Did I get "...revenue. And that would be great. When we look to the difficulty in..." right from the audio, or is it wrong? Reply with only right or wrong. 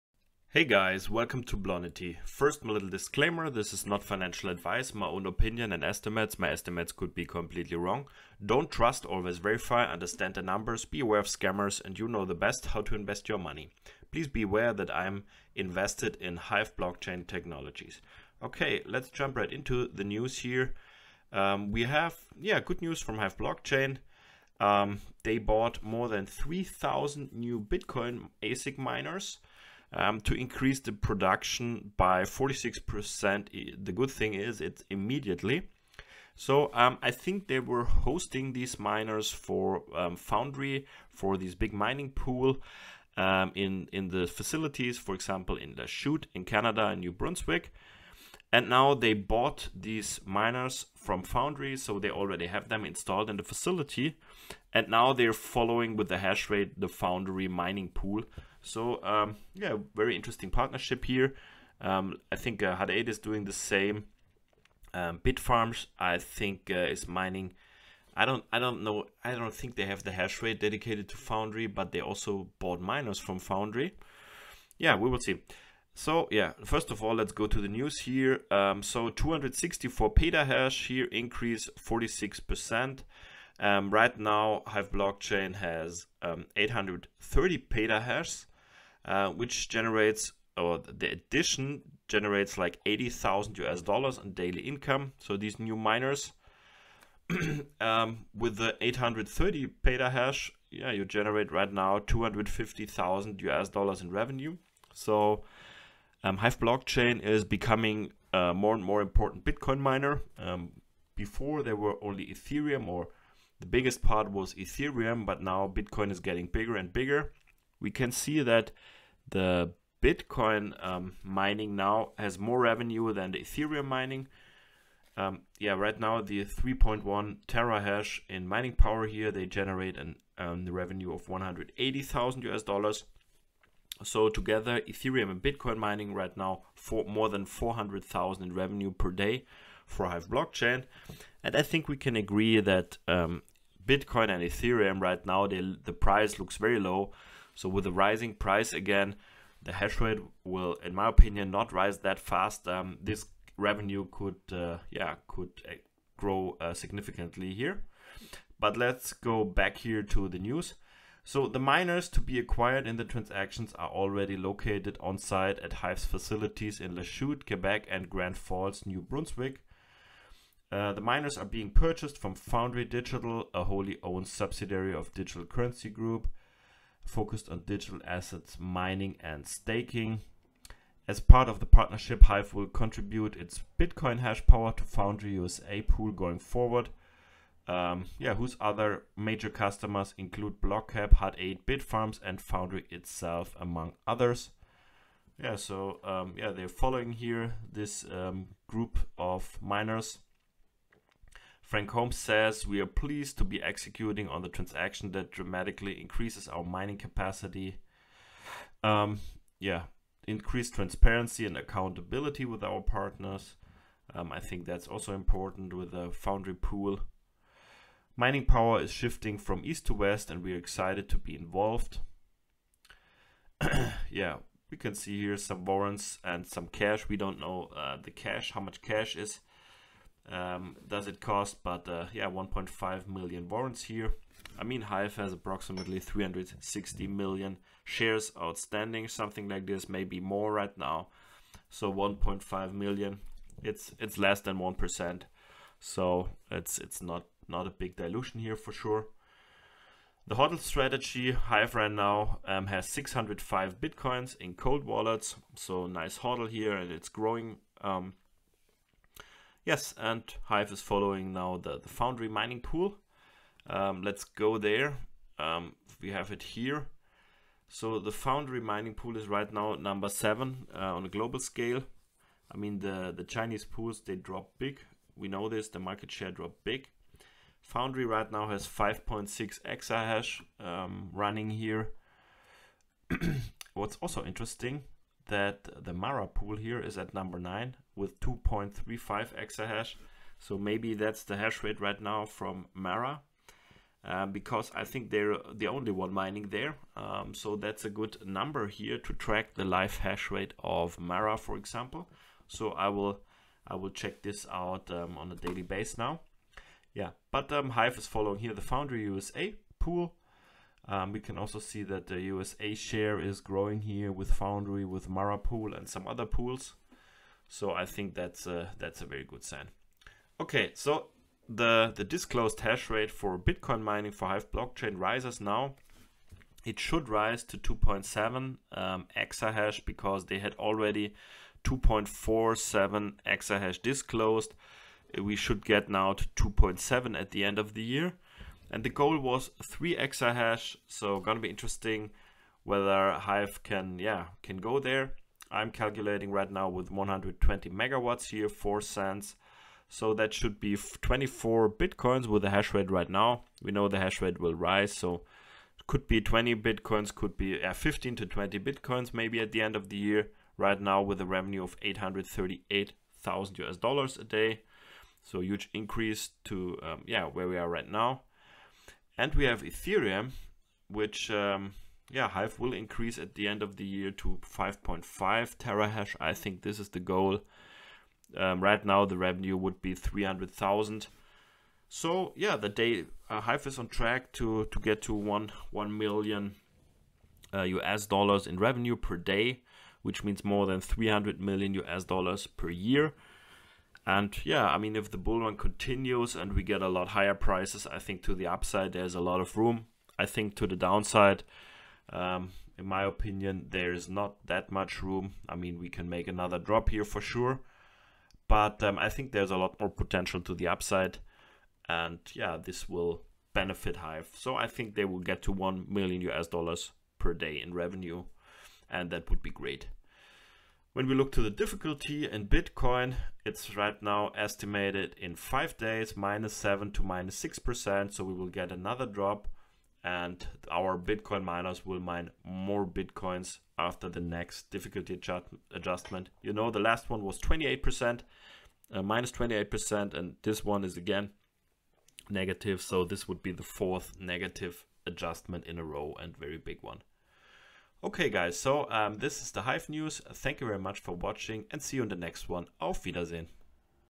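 right.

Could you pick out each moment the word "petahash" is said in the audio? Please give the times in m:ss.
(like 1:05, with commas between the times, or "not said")
1:20, 1:27, 1:39.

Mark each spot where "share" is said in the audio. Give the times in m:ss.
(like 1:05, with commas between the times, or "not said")
3:57, 4:36, 5:12.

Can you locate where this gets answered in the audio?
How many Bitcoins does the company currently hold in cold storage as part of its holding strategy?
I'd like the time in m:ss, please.
4:12.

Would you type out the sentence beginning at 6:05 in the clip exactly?
So huge increase to um, yeah where we are right now.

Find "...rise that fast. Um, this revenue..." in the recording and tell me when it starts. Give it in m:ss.
2:31.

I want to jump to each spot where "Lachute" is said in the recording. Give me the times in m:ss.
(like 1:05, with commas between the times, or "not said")
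0:45, 2:46.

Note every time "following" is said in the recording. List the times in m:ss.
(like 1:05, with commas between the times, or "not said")
0:55, 3:16, 4:20, 5:08.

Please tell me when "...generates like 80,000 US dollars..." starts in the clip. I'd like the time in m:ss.
1:32.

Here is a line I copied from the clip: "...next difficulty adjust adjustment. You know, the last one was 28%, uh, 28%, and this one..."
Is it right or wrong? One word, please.
right.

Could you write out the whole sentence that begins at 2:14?
So together, Ethereum and Bitcoin mining right now for more than 400,000 in revenue per day for Hive blockchain.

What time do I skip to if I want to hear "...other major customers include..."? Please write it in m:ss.
3:08.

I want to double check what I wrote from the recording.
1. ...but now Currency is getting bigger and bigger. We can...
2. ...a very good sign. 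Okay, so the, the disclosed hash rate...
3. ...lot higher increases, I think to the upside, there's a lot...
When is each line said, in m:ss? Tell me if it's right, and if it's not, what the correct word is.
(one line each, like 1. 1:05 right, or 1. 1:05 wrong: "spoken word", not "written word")
1. 1:55 wrong: "Bitcoin", not "Currency"
2. 5:19 right
3. 6:36 wrong: "prices", not "increases".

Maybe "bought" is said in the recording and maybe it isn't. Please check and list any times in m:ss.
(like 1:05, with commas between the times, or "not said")
0:25, 0:49, 1:12.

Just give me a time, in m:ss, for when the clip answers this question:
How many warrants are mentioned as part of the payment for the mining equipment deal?
3:52.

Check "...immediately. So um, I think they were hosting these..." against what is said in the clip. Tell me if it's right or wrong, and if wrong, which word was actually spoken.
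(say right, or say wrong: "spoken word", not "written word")
right.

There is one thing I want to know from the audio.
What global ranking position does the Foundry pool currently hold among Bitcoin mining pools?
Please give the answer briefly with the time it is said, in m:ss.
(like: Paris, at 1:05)
Number 7, at 4:29.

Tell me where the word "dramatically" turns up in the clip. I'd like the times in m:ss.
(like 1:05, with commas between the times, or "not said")
3:25.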